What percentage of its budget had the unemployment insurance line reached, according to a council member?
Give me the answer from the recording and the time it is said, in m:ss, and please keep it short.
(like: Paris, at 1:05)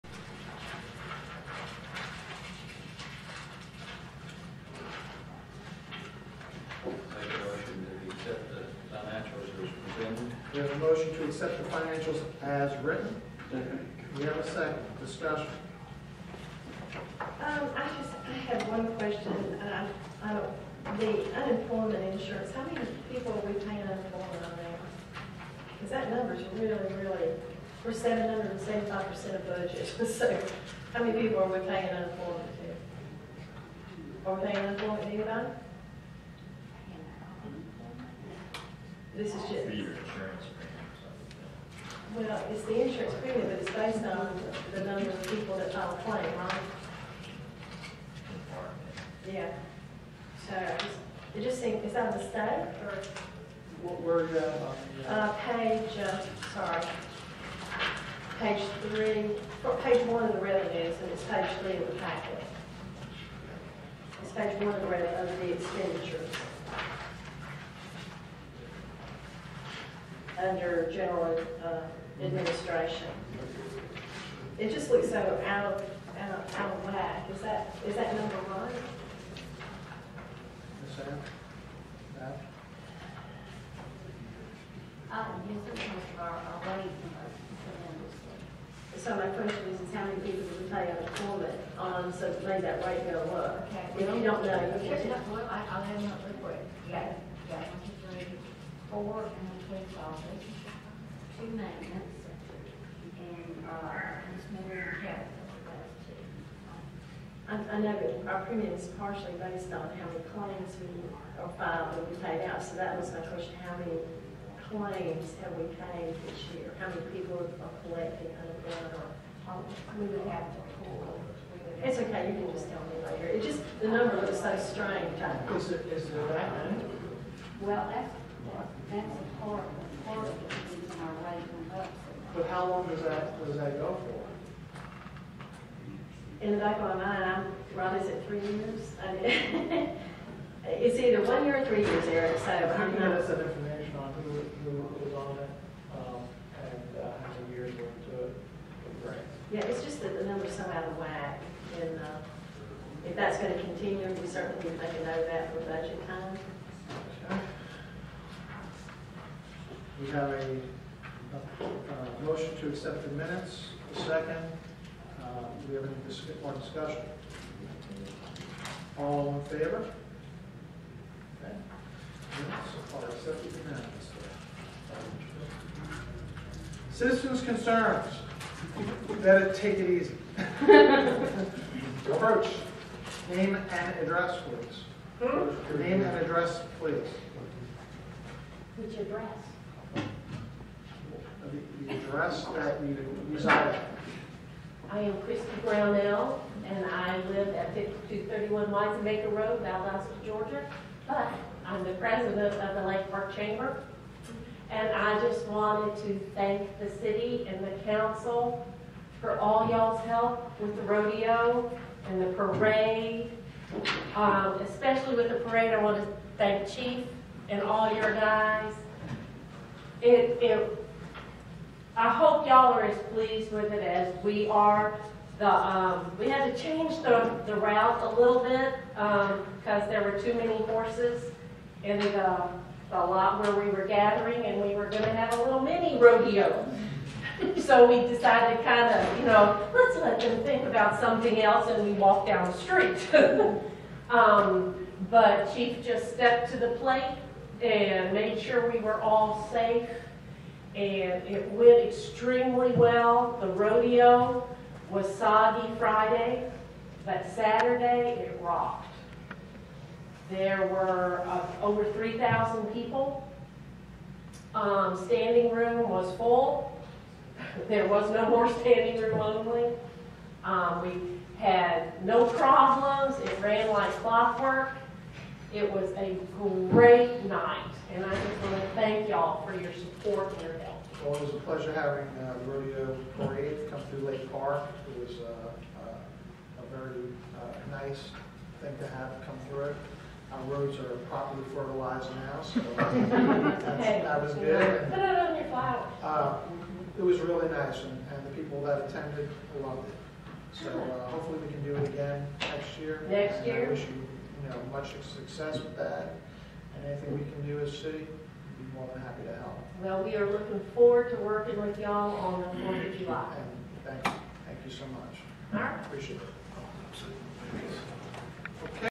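775%, at 0:27.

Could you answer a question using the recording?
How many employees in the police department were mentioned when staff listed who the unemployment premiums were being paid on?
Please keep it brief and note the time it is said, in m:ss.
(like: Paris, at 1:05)
4, at 1:38.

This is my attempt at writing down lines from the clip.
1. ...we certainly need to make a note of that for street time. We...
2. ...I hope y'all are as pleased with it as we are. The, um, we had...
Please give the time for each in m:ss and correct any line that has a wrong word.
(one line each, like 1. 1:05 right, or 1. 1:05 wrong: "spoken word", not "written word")
1. 2:34 wrong: "budget", not "street"
2. 3:42 right.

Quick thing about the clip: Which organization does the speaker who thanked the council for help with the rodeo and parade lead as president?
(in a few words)
Lake Park Chamber.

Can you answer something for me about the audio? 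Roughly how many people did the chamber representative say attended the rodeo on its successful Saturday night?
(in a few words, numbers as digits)
over 3,000.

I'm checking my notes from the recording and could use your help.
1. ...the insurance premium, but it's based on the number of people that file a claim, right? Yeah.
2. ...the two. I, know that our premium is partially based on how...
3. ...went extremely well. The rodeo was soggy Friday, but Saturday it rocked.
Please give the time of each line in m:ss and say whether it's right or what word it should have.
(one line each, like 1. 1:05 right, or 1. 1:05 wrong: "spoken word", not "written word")
1. 0:42 right
2. 1:45 right
3. 4:11 right.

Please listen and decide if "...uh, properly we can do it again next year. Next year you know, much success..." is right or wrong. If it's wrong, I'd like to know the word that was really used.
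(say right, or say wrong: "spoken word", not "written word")
wrong: "hopefully", not "properly".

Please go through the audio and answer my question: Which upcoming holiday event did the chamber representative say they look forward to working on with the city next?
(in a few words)
Fourth of July.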